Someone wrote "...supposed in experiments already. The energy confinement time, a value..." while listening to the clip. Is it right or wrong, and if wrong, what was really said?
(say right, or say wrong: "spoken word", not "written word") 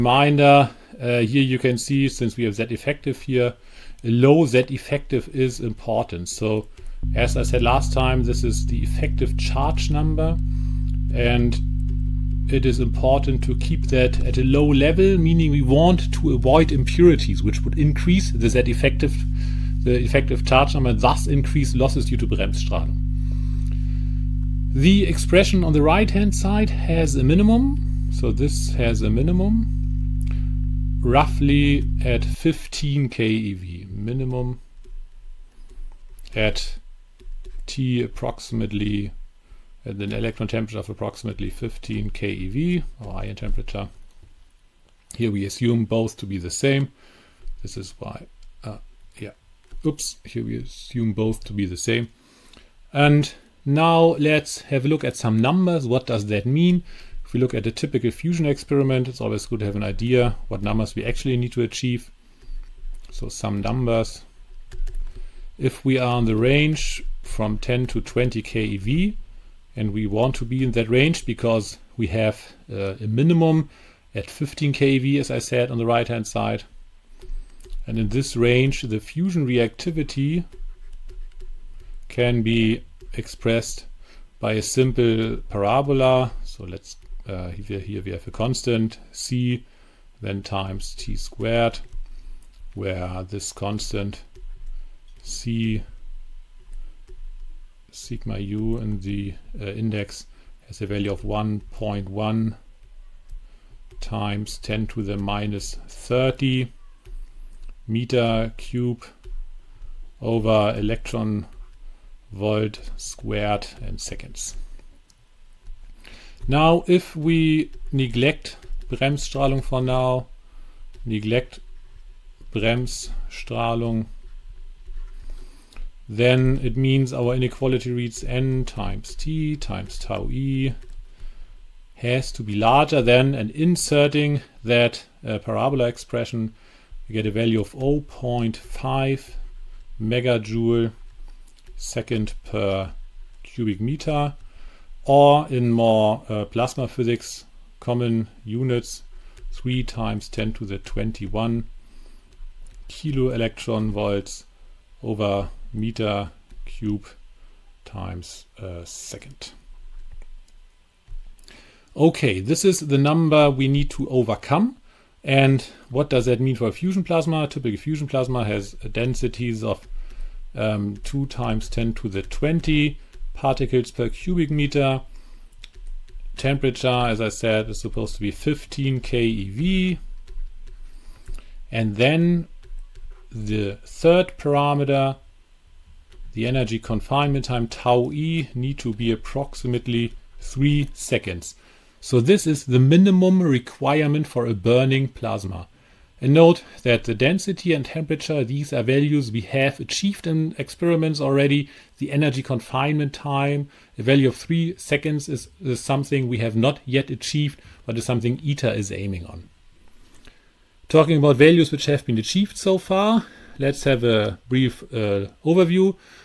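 wrong: "achieved", not "supposed".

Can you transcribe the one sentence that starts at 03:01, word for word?
And then the third parameter the energy confinement time tau e need to be approximately 3 seconds.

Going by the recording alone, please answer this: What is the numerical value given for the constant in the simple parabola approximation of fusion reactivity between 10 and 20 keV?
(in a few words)
1.1 times 10^-30.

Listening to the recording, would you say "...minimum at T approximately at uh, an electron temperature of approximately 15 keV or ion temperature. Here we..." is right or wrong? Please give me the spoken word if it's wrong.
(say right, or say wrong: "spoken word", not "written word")
right.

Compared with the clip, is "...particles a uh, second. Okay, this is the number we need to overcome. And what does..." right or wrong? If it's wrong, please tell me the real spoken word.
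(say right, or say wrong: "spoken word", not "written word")
wrong: "times", not "particles".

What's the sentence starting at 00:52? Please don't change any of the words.
And now let's have a look at some numbers.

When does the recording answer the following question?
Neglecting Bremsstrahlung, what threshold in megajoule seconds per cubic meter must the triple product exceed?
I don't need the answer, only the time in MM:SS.
02:17.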